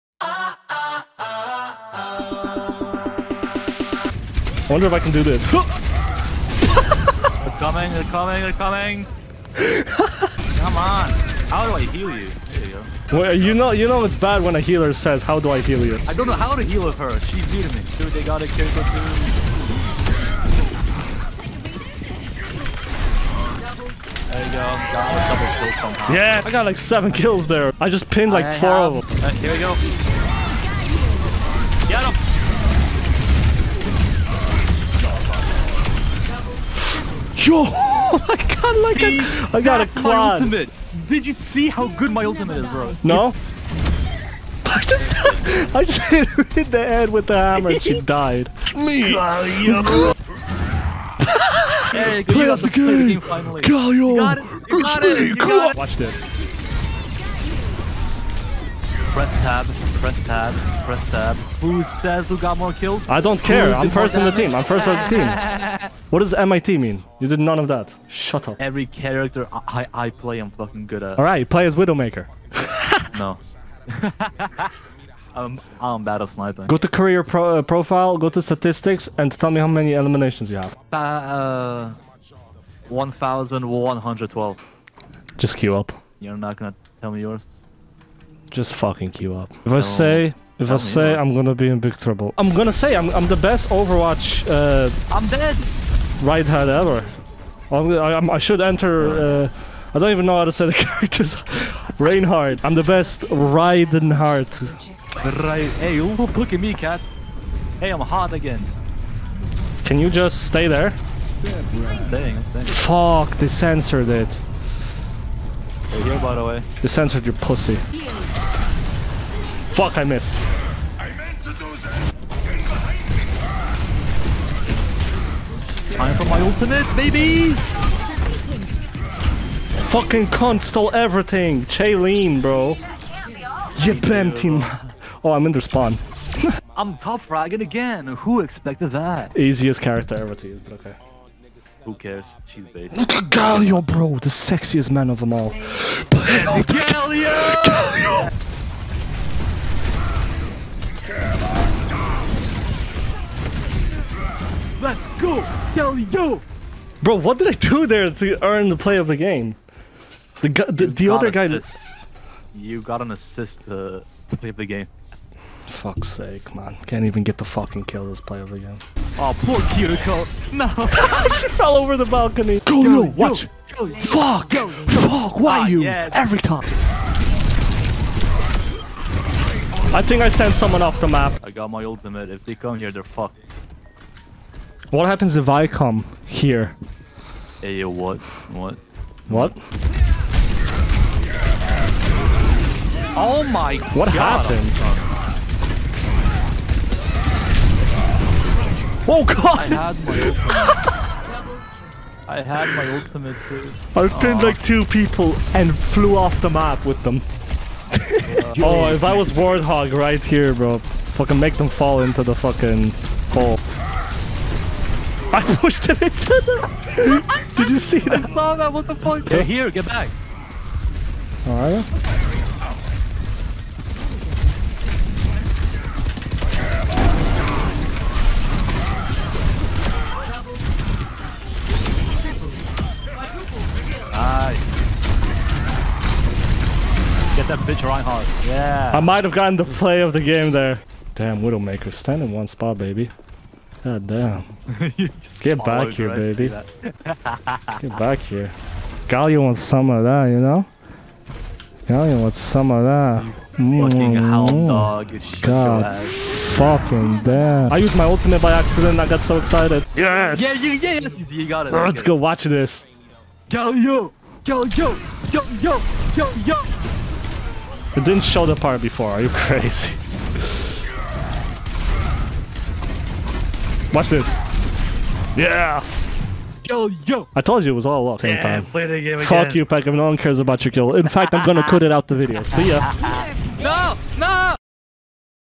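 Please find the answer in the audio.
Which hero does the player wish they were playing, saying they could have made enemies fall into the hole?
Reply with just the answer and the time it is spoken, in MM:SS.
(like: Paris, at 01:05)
Warthog, at 03:29.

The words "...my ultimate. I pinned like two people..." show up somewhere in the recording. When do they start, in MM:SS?
03:22.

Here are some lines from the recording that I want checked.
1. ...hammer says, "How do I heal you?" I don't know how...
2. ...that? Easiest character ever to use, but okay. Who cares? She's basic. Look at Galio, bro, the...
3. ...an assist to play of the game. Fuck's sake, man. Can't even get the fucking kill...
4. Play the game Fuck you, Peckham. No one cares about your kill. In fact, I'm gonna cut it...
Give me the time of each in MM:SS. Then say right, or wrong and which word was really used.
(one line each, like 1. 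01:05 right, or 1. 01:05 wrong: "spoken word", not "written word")
1. 00:14 wrong: "healer", not "hammer"
2. 02:18 right
3. 02:43 right
4. 04:38 right.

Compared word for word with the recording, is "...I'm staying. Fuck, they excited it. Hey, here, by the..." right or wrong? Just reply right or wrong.
wrong.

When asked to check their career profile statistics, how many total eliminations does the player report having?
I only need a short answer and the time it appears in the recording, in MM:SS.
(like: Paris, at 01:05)
1,112, at 01:22.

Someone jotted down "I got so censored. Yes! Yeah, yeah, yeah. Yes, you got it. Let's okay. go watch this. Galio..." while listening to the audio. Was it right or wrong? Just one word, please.
wrong.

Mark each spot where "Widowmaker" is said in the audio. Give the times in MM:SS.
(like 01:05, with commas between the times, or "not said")
01:11, 04:01.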